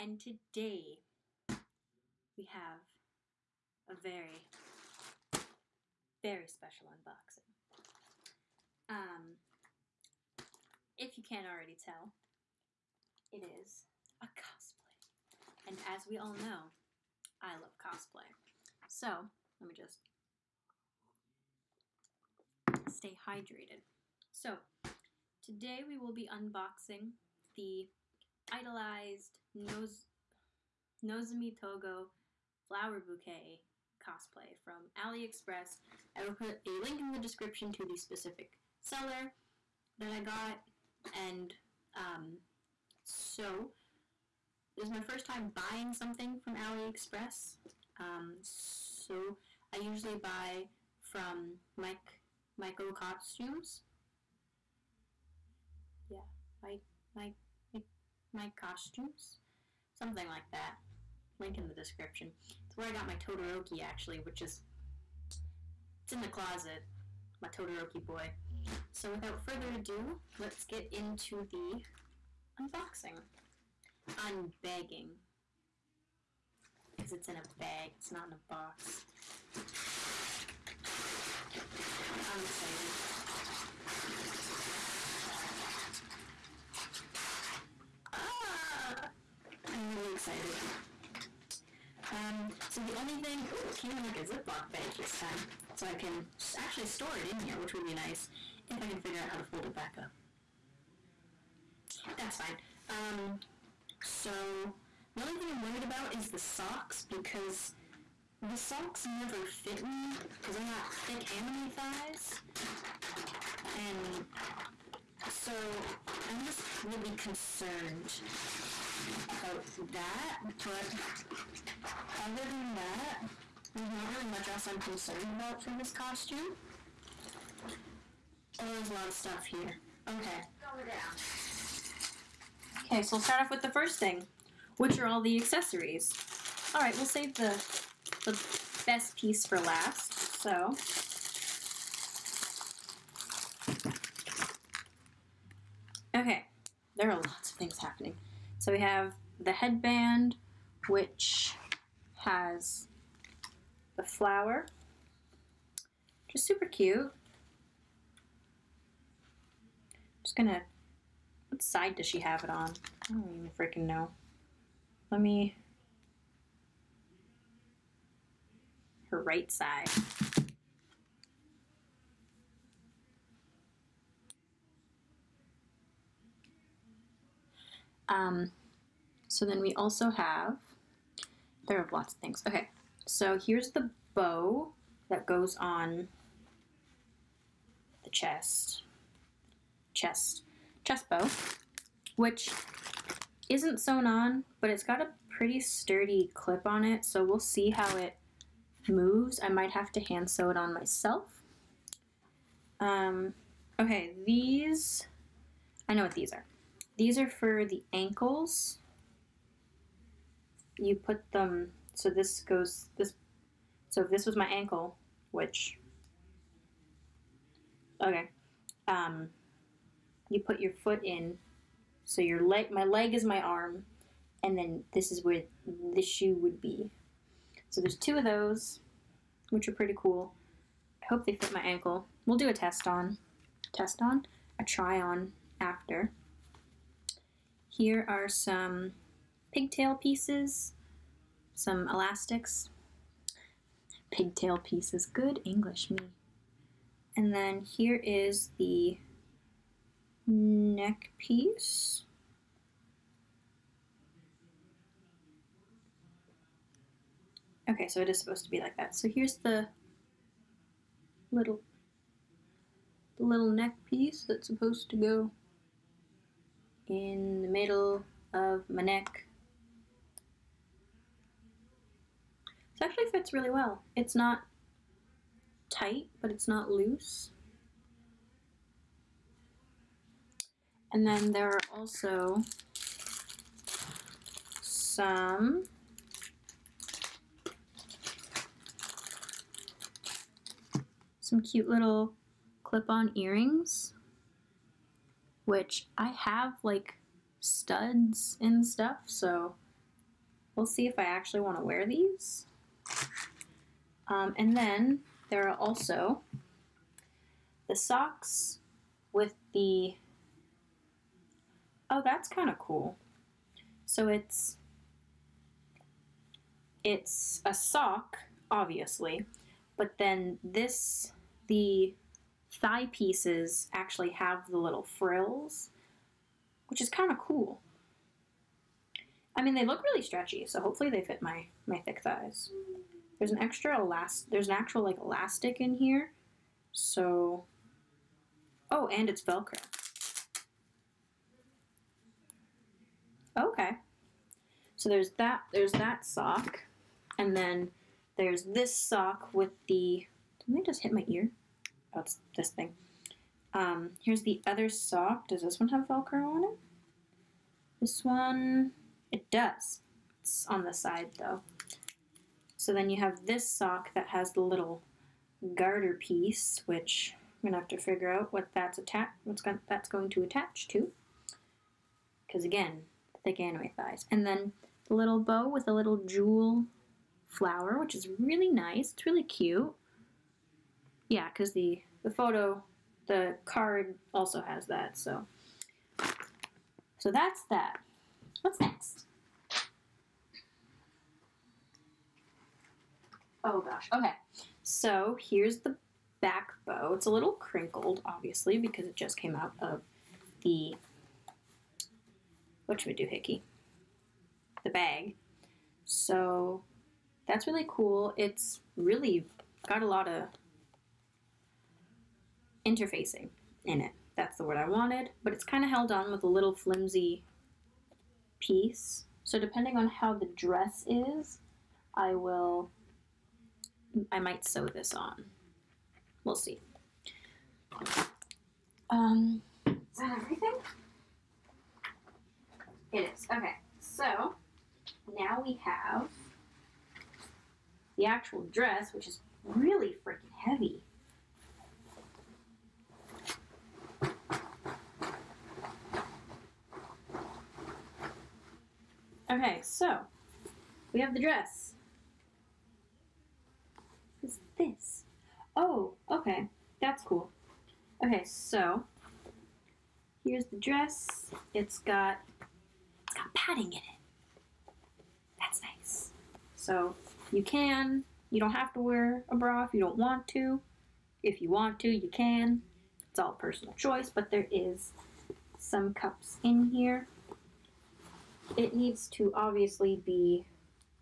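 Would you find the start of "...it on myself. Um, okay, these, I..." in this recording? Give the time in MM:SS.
03:20.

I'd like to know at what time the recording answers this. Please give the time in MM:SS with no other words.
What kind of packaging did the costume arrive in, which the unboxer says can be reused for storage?
01:34.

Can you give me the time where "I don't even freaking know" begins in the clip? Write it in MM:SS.
02:43.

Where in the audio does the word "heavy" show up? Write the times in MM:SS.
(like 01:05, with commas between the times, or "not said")
07:20.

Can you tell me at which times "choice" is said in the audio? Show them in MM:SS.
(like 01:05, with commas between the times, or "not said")
07:53.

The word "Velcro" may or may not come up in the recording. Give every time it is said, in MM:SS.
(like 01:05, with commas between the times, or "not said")
05:39, 05:55.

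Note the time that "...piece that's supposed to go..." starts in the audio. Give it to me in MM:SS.
04:23.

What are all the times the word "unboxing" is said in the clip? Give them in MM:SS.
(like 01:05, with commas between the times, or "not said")
00:06, 00:26, 01:12.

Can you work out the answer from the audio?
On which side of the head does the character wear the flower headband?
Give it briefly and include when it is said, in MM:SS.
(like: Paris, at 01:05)
her right side, at 02:49.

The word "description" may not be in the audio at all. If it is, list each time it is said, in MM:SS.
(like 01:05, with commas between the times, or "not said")
00:37, 01:01.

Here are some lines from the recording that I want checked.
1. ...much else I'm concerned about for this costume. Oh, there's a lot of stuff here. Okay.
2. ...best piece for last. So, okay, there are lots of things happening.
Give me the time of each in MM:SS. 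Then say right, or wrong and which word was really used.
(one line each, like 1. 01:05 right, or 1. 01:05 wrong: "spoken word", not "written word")
1. 02:04 right
2. 02:18 right.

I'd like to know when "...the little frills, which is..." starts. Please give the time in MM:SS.
05:24.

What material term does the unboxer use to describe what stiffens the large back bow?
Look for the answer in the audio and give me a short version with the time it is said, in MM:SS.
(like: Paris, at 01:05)
interfacing, at 06:52.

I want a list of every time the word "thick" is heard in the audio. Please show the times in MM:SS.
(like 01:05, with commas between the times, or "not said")
01:50, 05:31, 06:13.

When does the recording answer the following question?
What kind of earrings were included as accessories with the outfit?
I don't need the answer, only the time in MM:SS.
04:52.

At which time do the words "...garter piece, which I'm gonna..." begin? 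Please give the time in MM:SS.
06:05.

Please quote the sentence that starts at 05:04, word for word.
Um, and then there are also the socks with the, oh, that's kind of cool.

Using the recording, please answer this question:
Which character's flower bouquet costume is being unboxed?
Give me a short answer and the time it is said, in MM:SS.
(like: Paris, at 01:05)
Nozomi Togo, at 00:31.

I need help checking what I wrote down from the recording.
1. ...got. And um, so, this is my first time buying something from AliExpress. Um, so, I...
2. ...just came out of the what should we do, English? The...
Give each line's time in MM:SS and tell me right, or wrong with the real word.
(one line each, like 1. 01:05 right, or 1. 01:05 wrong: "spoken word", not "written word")
1. 00:40 right
2. 06:38 wrong: "Hickey", not "English".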